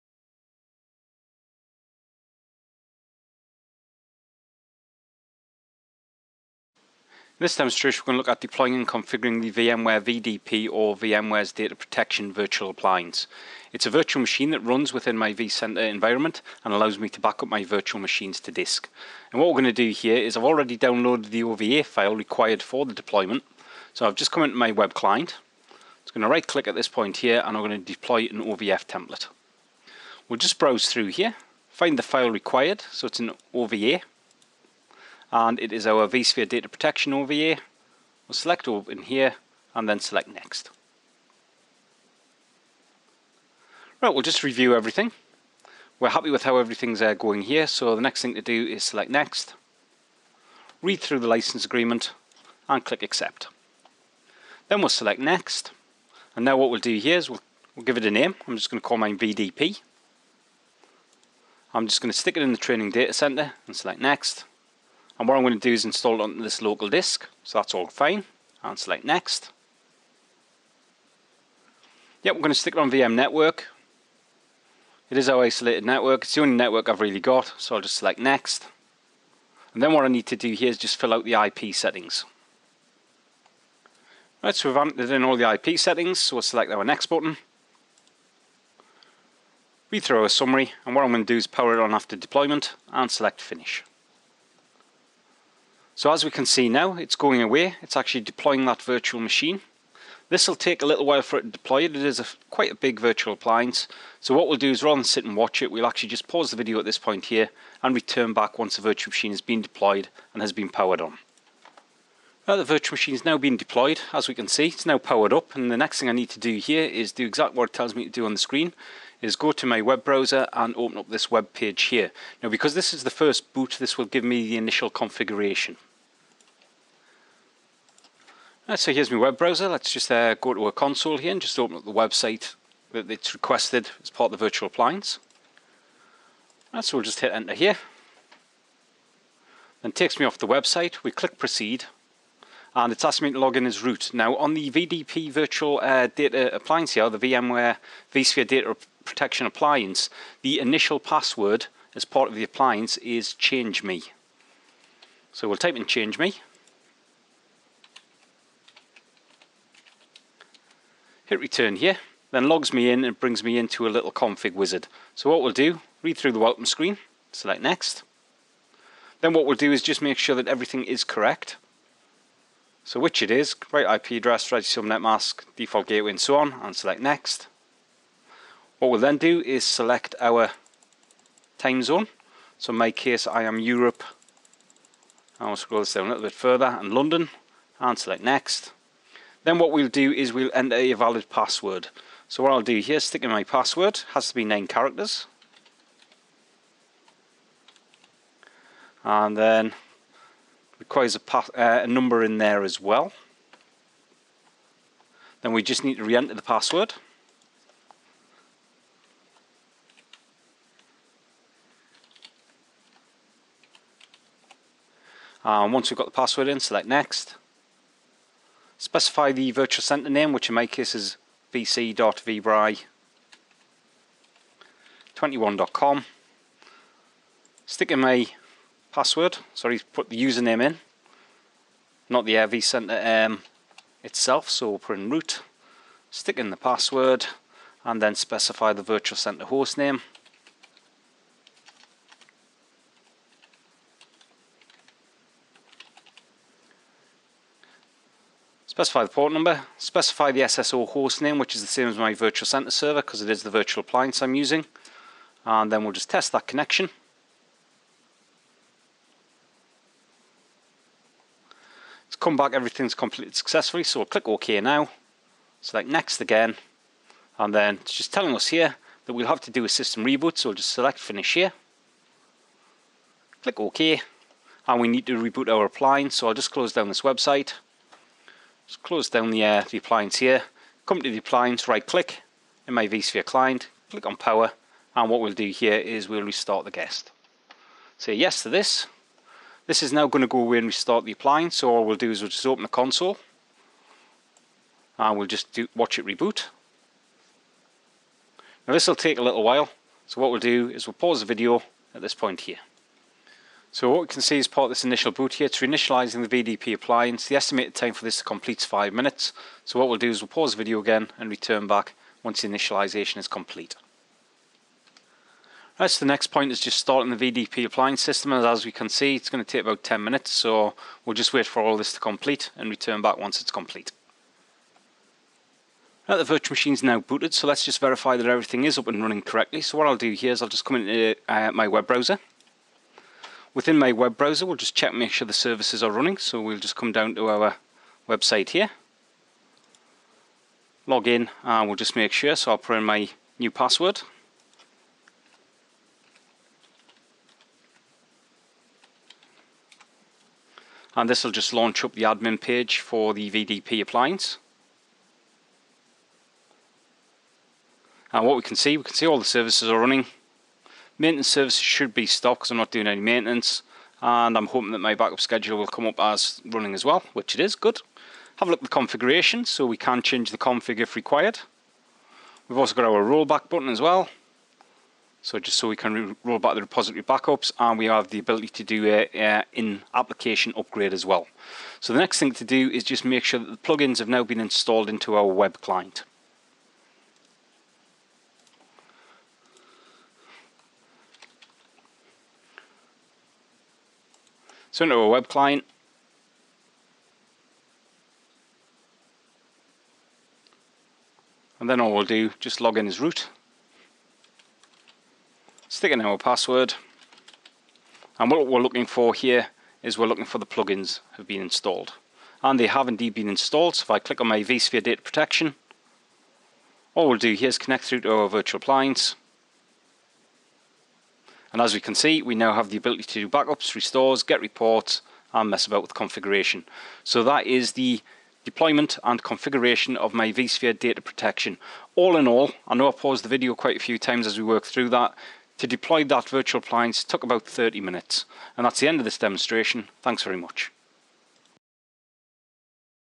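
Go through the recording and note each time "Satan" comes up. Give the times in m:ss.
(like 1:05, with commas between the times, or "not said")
not said.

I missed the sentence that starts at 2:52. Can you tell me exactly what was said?
So which it is, right IP address, register subnet mask, default gateway and so on, and select next.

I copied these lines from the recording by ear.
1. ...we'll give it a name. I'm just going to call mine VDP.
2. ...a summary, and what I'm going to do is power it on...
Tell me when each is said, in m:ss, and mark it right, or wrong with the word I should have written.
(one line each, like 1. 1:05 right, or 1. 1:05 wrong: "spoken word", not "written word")
1. 0:57 right
2. 1:30 right.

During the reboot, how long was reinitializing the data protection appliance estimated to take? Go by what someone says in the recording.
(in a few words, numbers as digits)
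5 minutes.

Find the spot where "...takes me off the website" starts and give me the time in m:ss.
2:19.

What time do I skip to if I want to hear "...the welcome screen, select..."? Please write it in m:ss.
2:46.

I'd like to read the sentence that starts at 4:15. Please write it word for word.
And then we'll just test that connection.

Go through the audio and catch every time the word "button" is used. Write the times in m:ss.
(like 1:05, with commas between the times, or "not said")
1:27, 6:13.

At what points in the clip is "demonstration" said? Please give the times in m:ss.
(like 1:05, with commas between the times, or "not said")
0:07, 7:19.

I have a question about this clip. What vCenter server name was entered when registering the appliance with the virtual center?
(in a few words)
vc.vbry21.com.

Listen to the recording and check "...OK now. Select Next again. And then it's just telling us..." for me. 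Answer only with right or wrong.
right.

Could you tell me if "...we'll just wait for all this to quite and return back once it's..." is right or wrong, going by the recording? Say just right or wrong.
wrong.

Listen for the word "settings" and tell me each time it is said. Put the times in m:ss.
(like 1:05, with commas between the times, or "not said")
1:21, 1:25.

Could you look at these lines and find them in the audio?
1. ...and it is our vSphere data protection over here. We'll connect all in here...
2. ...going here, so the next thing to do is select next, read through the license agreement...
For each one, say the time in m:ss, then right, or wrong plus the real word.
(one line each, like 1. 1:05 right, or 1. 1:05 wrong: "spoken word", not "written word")
1. 0:35 wrong: "select", not "connect"
2. 0:47 right.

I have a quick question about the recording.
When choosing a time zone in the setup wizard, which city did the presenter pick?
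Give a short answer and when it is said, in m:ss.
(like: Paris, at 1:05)
London, at 3:06.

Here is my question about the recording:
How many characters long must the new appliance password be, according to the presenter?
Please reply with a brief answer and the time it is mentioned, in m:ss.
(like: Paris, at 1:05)
9, at 3:14.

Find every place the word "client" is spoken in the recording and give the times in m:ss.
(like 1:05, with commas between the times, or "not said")
0:24, 4:43, 6:25, 6:35.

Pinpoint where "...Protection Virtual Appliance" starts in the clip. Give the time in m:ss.
0:11.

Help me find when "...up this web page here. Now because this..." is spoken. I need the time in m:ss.
2:00.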